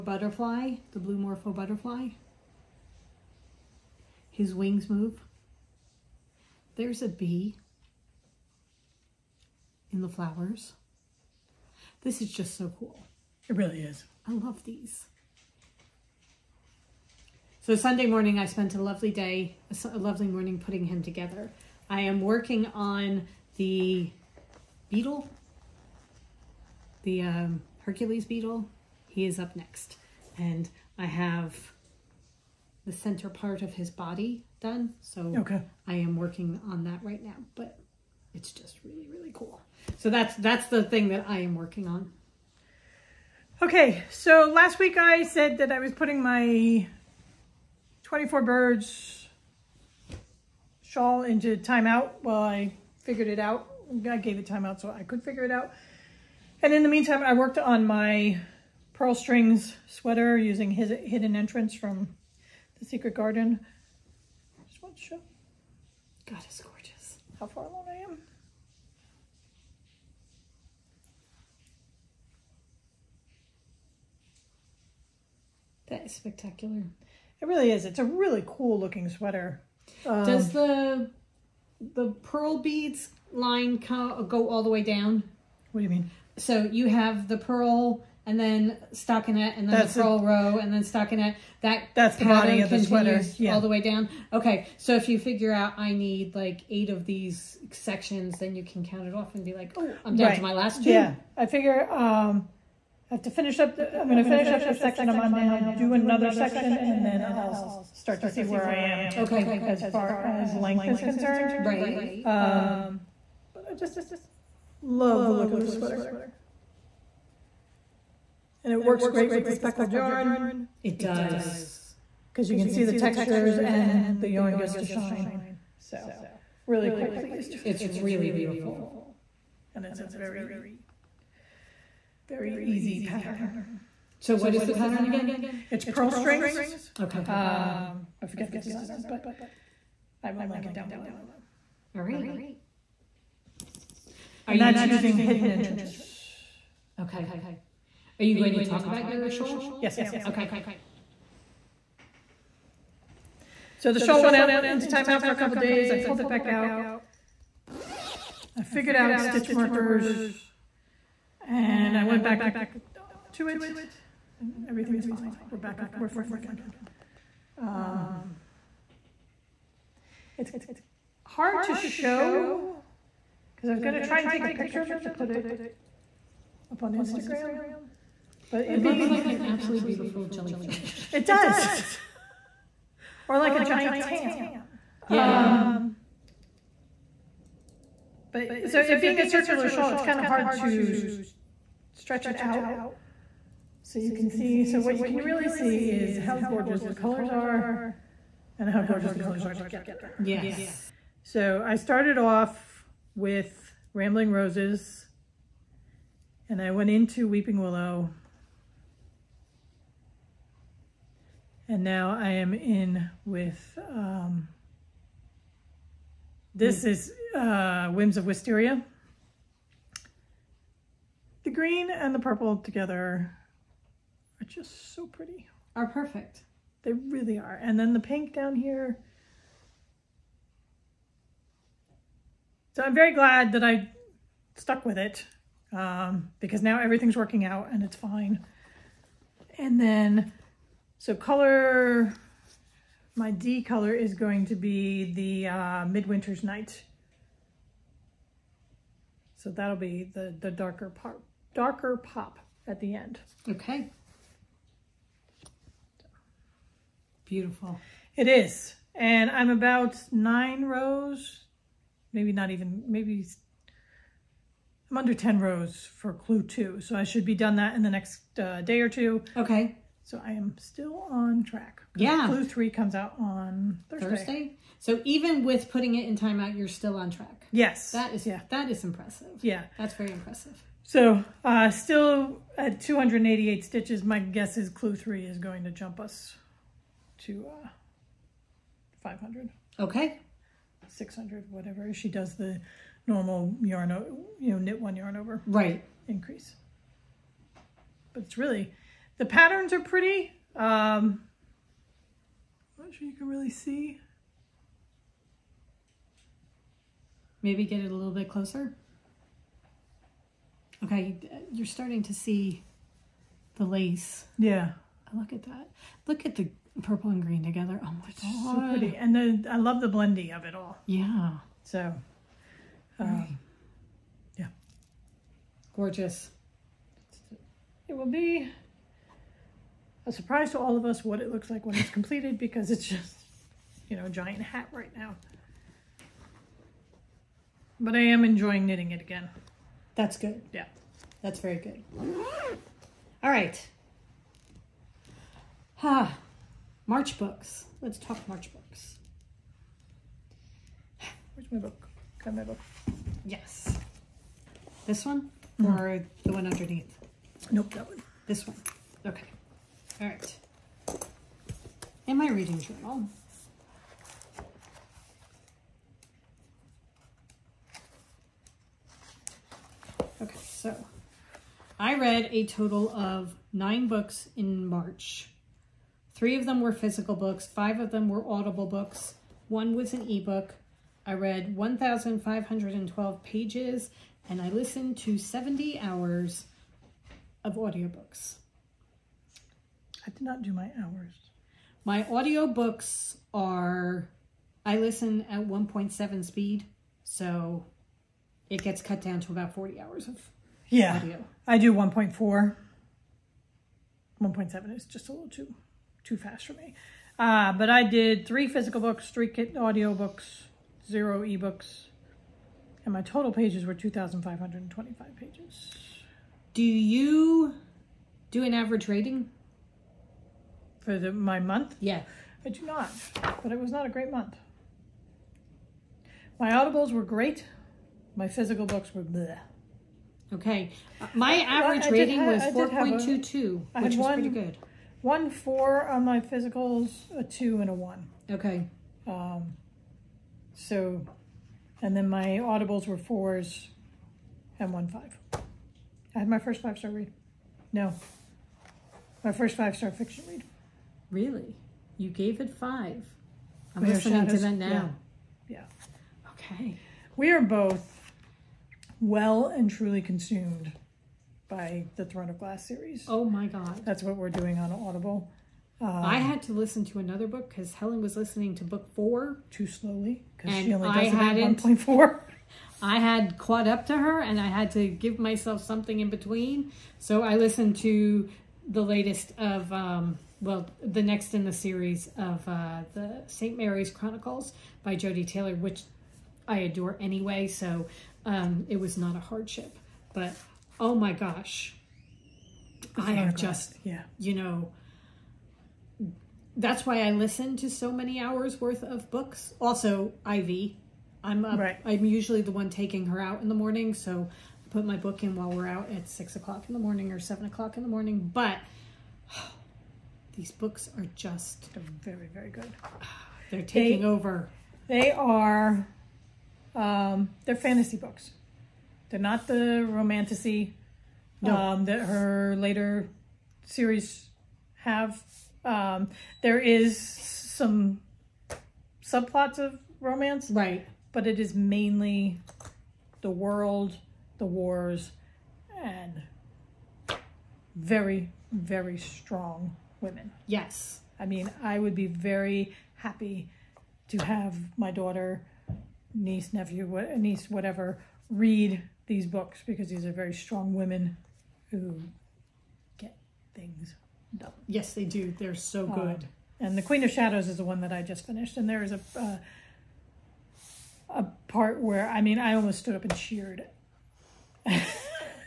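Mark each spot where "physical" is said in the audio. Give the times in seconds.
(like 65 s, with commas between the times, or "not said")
376 s, 408 s, 428 s, 436 s.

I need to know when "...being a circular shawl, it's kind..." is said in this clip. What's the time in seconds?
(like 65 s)
189 s.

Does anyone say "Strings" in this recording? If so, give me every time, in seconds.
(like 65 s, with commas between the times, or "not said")
59 s, 136 s.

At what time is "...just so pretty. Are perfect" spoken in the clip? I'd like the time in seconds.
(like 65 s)
224 s.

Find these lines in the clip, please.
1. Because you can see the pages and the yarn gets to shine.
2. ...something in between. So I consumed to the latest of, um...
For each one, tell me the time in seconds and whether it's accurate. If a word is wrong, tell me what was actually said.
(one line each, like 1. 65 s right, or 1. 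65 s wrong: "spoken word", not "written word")
1. 122 s wrong: "textures", not "pages"
2. 475 s wrong: "listened", not "consumed".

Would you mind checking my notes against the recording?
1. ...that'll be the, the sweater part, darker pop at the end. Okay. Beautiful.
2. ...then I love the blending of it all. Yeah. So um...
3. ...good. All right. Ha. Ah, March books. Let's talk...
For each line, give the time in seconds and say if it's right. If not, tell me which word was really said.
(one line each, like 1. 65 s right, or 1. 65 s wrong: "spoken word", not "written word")
1. 249 s wrong: "darker", not "sweater"
2. 319 s right
3. 341 s right.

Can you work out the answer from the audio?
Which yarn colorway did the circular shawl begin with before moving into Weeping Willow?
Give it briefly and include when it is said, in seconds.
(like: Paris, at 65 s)
Rambling Roses, at 203 s.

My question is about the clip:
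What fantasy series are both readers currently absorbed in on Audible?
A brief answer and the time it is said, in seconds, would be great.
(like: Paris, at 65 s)
Throne of Glass, at 462 s.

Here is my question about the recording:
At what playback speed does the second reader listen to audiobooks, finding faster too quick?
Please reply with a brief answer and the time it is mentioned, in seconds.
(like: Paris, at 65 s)
1.4, at 401 s.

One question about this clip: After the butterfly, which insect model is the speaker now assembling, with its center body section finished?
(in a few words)
Hercules beetle.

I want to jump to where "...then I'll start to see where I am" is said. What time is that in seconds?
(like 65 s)
107 s.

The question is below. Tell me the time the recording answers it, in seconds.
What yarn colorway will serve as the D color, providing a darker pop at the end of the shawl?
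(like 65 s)
245 s.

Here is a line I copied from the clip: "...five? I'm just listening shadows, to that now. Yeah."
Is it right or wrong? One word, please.
right.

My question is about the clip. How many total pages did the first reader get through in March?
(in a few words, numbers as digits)
1,512.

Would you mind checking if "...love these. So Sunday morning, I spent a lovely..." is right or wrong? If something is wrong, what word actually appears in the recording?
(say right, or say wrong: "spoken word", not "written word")
right.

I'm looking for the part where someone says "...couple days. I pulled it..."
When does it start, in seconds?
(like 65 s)
155 s.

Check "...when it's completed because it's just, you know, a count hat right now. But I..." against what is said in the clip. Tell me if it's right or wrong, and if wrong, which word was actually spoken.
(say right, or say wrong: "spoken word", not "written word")
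wrong: "giant", not "count".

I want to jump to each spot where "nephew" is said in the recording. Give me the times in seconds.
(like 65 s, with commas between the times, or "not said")
546 s.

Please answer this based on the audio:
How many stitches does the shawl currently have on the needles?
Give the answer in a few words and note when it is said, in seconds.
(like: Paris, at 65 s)
288, at 282 s.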